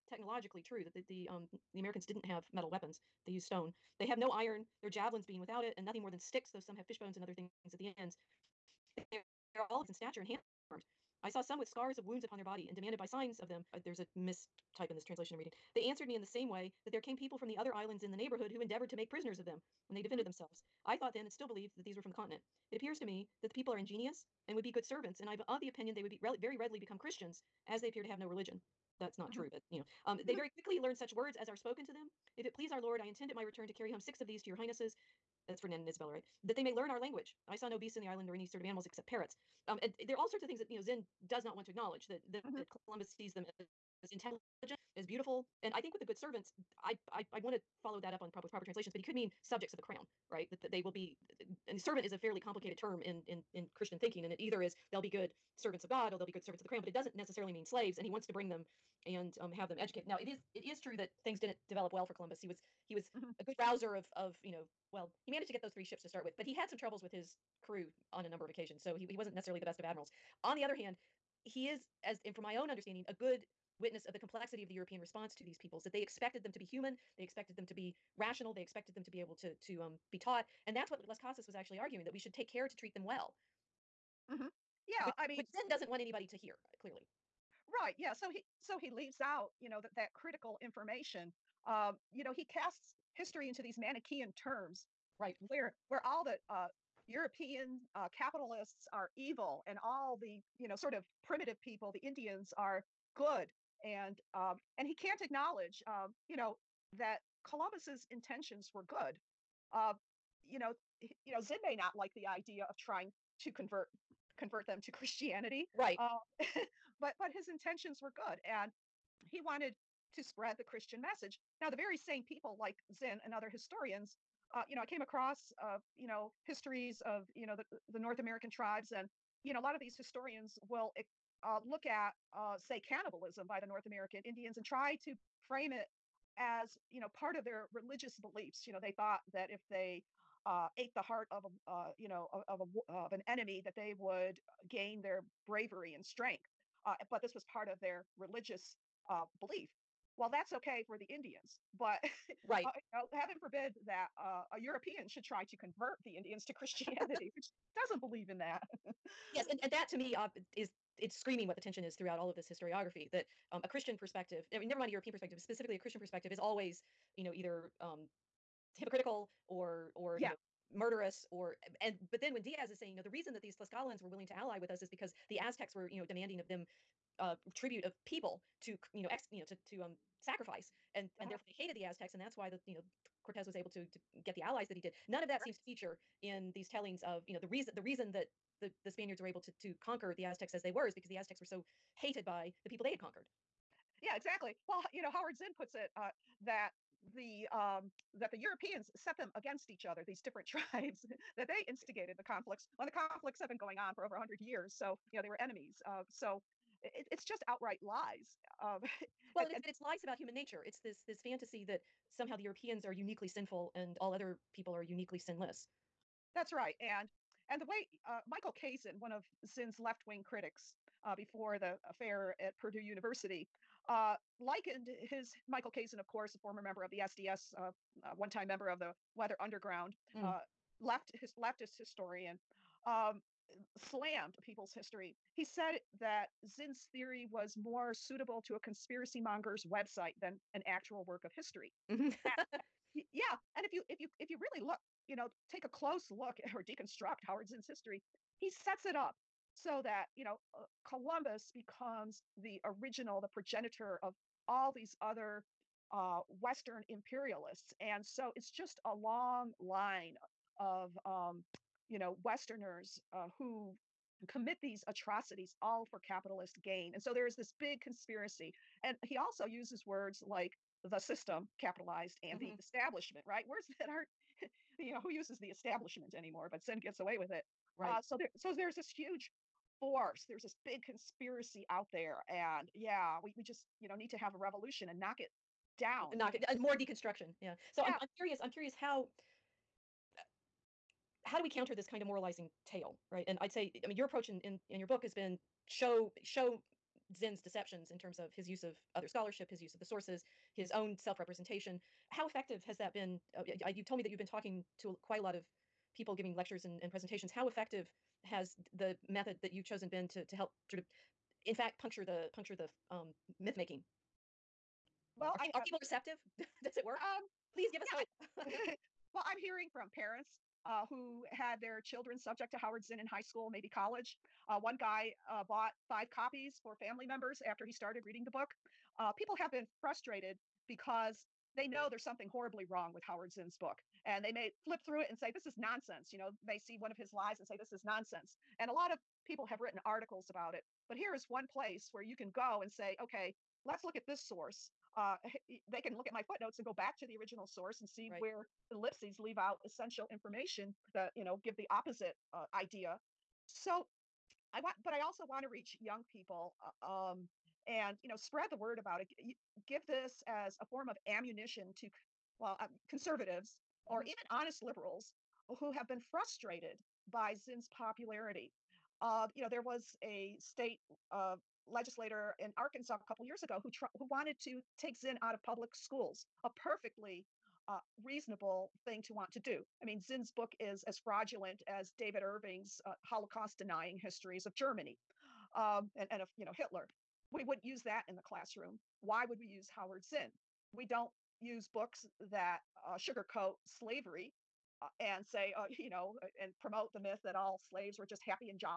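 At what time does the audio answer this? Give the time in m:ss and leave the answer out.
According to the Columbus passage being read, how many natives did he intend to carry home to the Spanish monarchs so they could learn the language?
0:33.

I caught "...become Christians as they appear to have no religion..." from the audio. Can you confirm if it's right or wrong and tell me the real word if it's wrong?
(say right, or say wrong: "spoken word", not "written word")
right.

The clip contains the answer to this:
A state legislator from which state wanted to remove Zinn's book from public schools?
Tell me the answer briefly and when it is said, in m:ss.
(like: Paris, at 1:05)
Arkansas, at 6:12.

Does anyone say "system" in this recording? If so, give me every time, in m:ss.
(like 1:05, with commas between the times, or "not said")
4:30.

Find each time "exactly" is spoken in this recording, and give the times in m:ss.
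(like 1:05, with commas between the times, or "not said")
3:14.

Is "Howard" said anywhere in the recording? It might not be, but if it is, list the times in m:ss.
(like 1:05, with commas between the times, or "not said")
3:15, 4:07, 5:22, 5:33, 6:29.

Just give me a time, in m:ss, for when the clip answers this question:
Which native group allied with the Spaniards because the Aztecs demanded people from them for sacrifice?
2:53.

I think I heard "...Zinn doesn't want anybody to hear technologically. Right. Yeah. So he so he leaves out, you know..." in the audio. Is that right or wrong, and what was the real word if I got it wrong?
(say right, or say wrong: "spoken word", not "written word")
wrong: "clearly", not "technologically".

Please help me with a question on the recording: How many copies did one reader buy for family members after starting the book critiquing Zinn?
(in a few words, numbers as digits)
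5.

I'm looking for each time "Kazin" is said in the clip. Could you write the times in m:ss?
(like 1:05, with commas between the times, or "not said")
3:38, 3:45.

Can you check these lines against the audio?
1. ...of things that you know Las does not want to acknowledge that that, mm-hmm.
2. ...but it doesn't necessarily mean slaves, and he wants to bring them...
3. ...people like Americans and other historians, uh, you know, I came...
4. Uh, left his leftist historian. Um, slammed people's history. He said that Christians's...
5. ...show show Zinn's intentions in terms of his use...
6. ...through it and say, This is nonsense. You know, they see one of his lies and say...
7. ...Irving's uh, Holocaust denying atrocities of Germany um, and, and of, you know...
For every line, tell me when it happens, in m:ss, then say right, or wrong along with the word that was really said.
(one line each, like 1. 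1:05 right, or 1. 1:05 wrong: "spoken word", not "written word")
1. 0:40 wrong: "Zinn", not "Las"
2. 0:56 right
3. 2:02 wrong: "Zinn", not "Americans"
4. 3:50 wrong: "Zinn", not "Christians"
5. 4:55 wrong: "deceptions", not "intentions"
6. 5:34 right
7. 6:22 wrong: "histories", not "atrocities".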